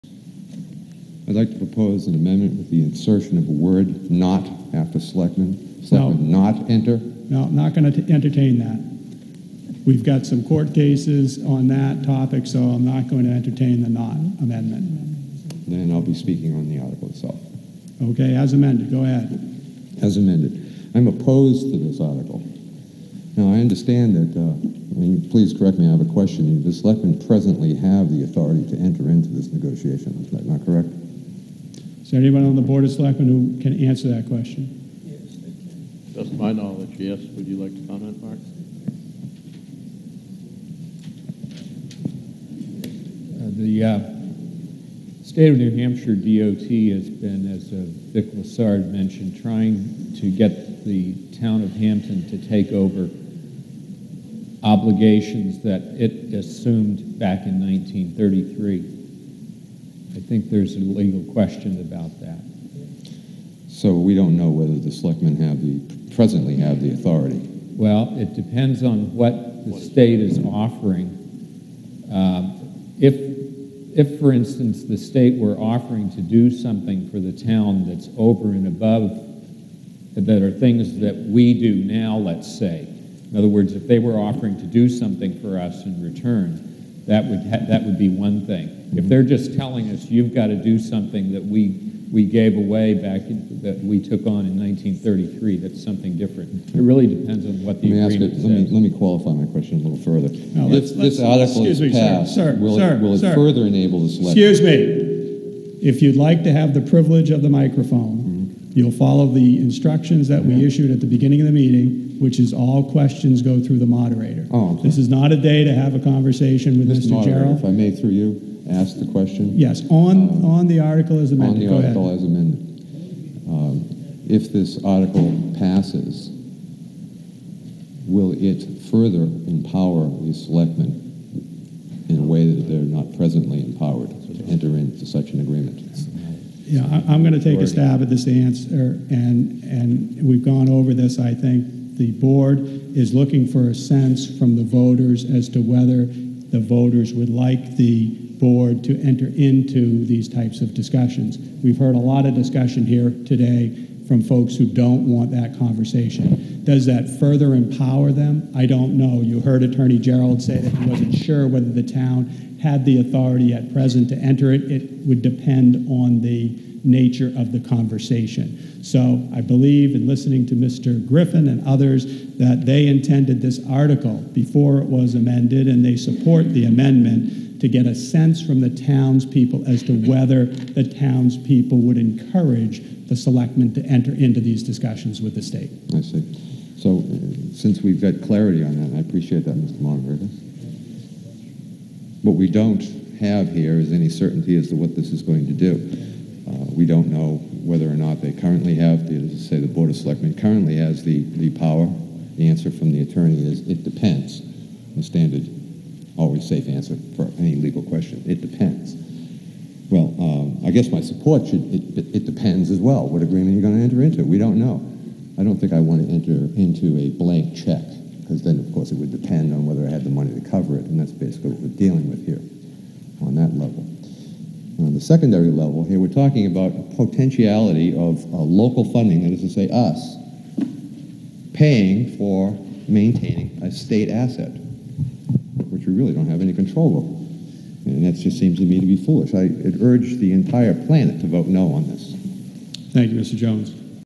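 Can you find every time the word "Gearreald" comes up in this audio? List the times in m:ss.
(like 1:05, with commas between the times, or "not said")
1:57, 2:39.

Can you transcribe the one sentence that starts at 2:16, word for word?
Yeah, I, am going to take a stab at this answer, and and we've gone over this.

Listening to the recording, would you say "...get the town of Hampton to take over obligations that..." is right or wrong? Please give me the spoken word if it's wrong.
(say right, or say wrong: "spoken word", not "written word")
right.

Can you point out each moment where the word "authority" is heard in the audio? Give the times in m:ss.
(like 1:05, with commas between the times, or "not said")
0:28, 1:06, 2:43.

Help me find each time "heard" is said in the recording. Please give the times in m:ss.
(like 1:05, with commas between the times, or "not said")
2:31, 2:39.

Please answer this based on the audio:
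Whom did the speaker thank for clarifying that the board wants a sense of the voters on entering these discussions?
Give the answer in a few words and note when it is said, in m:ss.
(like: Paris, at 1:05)
Mr. Longaberger, at 3:09.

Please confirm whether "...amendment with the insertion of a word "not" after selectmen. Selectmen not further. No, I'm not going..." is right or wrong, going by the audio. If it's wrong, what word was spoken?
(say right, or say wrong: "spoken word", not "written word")
wrong: "enter", not "further".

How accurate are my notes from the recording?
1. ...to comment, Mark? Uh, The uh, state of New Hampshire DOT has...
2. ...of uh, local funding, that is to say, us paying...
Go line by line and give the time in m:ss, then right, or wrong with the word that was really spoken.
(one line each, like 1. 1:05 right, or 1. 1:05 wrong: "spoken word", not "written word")
1. 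0:37 right
2. 3:47 right.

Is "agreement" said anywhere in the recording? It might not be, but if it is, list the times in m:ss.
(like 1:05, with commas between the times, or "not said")
1:38, 2:15, 3:33.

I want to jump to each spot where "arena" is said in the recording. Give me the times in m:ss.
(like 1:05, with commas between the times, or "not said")
not said.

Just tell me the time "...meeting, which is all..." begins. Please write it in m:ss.
1:51.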